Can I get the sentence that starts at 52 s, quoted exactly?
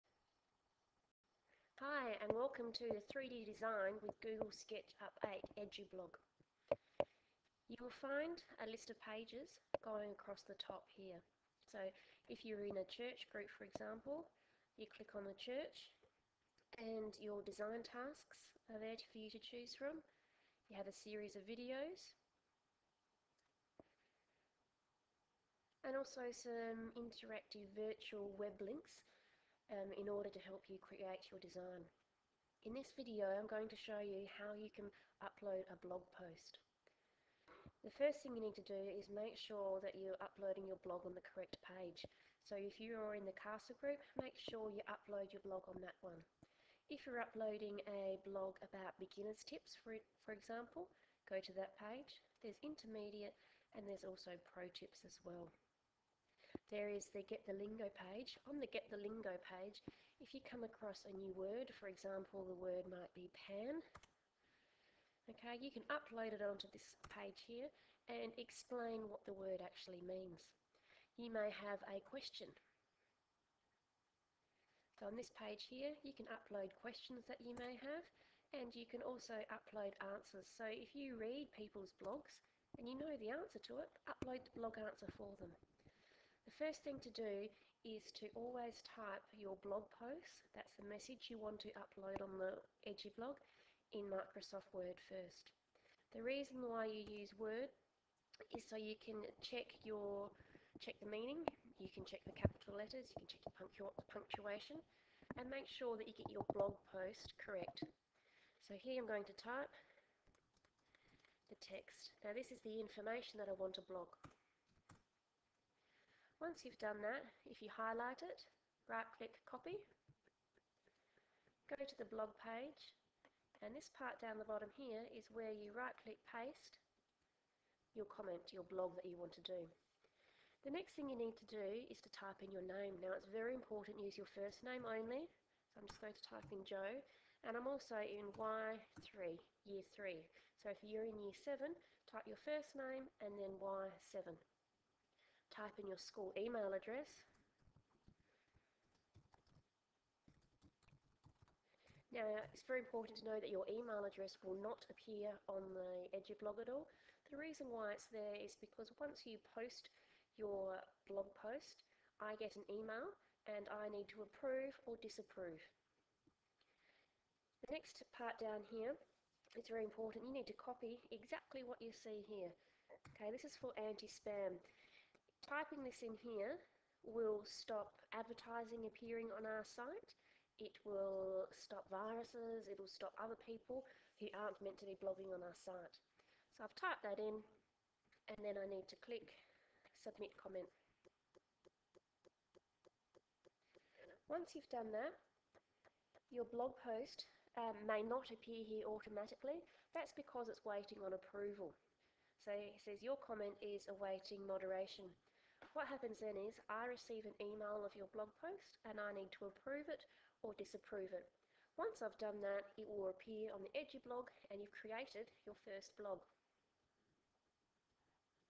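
There's intermediate and there's also pro tips as well there is the Get the Lingo page.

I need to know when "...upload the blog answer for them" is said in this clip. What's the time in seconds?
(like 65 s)
84 s.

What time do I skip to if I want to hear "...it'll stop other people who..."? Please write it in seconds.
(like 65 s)
182 s.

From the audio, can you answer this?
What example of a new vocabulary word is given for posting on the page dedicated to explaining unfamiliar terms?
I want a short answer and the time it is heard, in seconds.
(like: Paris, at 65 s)
pan, at 63 s.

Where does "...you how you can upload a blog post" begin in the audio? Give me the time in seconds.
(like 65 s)
34 s.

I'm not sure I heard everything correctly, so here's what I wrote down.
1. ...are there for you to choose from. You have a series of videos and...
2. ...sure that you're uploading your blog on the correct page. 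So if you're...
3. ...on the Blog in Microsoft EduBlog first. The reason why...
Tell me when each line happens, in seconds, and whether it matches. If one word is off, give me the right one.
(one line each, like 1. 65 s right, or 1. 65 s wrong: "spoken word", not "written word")
1. 18 s right
2. 39 s right
3. 92 s wrong: "Word", not "EduBlog".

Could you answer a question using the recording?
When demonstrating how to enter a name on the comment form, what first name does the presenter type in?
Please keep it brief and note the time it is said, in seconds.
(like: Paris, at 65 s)
Joe, at 136 s.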